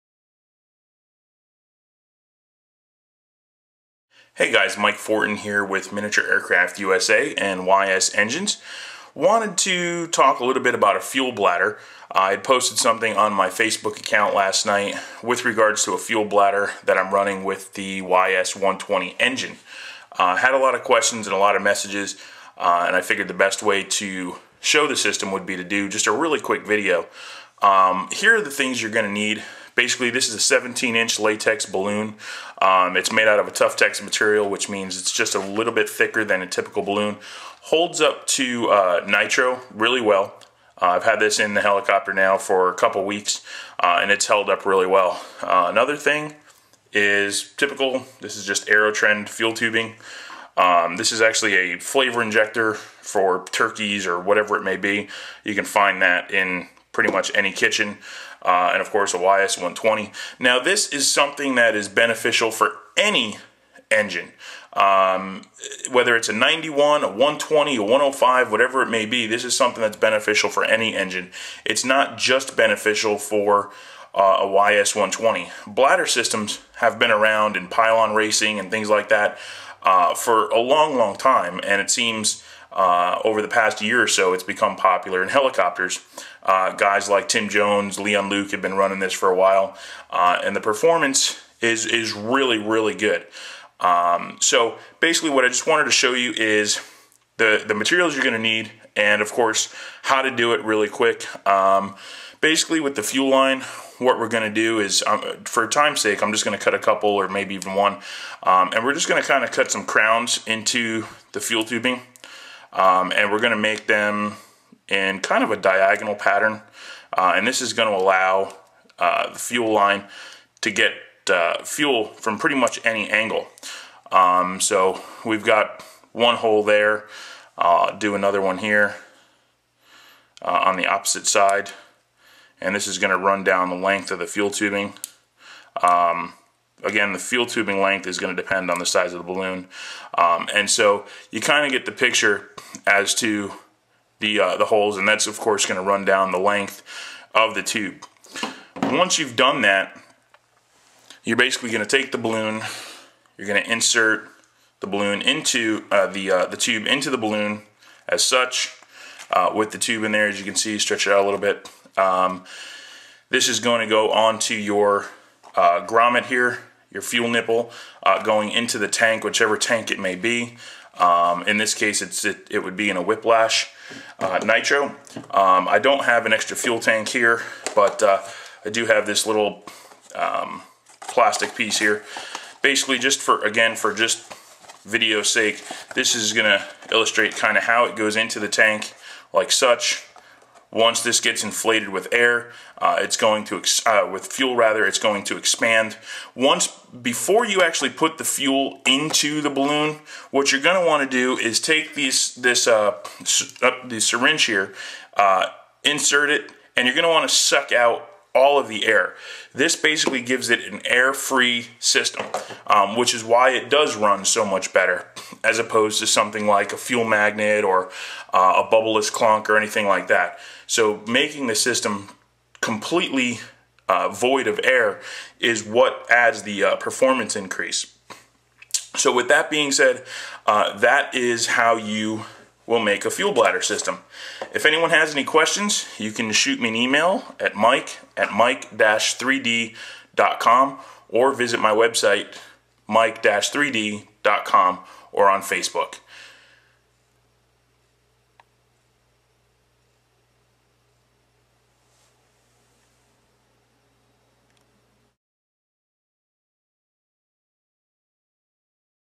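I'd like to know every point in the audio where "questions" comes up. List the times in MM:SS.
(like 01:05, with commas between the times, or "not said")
00:20, 03:55.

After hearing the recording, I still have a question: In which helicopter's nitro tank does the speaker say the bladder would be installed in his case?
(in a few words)
Whiplash.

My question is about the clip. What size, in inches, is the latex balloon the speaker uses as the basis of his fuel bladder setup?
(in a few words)
17 inch.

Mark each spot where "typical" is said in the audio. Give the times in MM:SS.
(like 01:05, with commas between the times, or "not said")
00:36, 00:47.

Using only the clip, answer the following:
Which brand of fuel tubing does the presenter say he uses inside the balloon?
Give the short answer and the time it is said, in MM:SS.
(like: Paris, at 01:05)
AeroTrend, at 00:48.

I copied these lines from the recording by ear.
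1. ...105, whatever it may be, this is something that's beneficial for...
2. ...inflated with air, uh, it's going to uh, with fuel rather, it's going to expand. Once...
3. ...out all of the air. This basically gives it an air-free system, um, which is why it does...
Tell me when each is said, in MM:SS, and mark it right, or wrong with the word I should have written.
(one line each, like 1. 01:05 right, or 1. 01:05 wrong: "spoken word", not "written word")
1. 01:07 right
2. 03:11 right
3. 03:27 right.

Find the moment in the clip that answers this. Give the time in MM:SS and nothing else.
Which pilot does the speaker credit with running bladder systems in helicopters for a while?
01:27.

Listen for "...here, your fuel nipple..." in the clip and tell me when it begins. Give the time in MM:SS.
02:46.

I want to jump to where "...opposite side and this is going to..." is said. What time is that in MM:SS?
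02:10.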